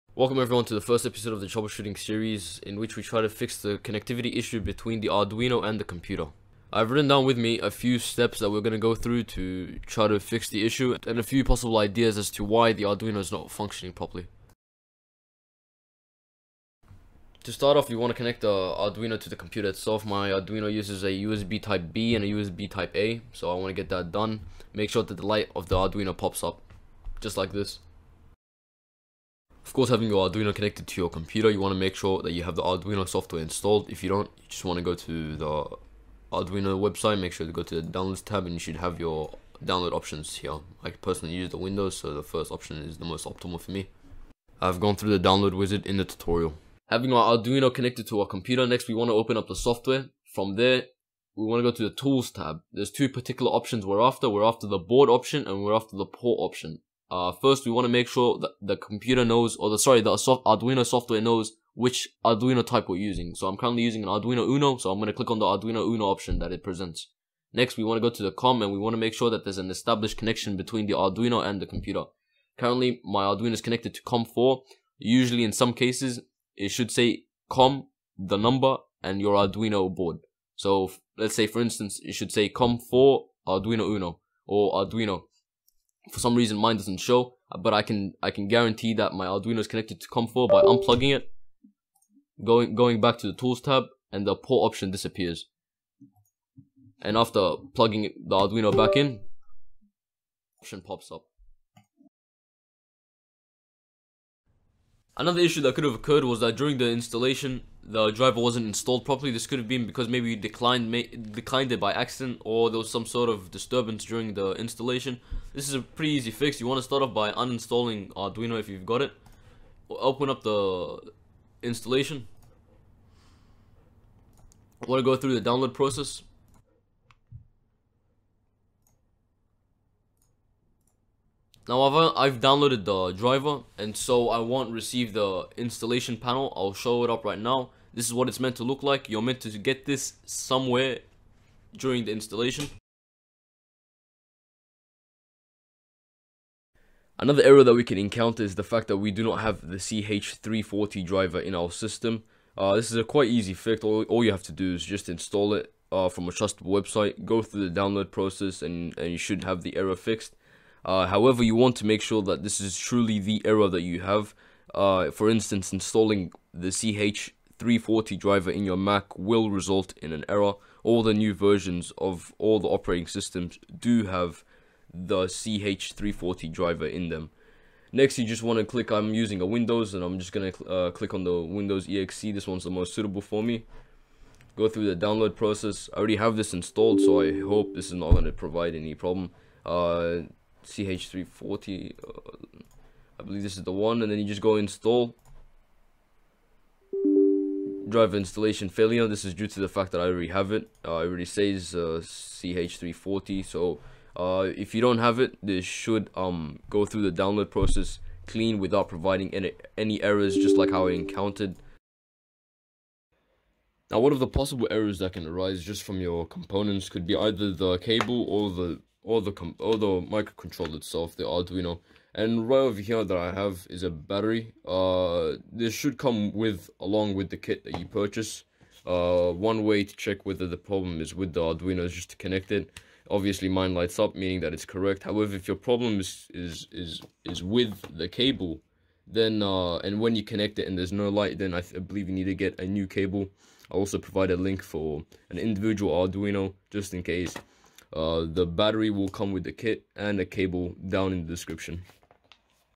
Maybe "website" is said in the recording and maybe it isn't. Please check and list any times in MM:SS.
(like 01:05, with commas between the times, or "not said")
00:36, 02:36.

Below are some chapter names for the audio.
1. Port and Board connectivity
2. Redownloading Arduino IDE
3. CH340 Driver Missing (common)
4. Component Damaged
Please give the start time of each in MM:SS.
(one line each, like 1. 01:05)
1. 00:14
2. 01:43
3. 02:23
4. 03:32.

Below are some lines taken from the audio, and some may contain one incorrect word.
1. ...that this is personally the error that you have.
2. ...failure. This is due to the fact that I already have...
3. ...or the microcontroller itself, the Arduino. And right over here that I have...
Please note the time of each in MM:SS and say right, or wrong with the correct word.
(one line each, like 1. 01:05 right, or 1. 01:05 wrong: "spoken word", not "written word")
1. 02:42 wrong: "truly", not "personally"
2. 03:18 right
3. 03:39 right.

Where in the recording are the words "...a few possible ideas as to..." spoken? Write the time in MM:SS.
00:11.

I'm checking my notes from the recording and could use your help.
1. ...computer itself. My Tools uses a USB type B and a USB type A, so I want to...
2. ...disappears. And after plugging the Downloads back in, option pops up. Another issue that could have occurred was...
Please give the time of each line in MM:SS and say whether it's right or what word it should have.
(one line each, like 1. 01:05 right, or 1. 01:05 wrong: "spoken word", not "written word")
1. 00:19 wrong: "Arduino", not "Tools"
2. 01:34 wrong: "Arduino", not "Downloads".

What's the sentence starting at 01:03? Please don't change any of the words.
So I'm currently using an Arduino Uno, so I'm going to click on the Arduino Uno option that it presents.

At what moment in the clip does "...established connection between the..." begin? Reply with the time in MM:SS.
01:09.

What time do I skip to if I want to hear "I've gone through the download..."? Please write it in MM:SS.
00:44.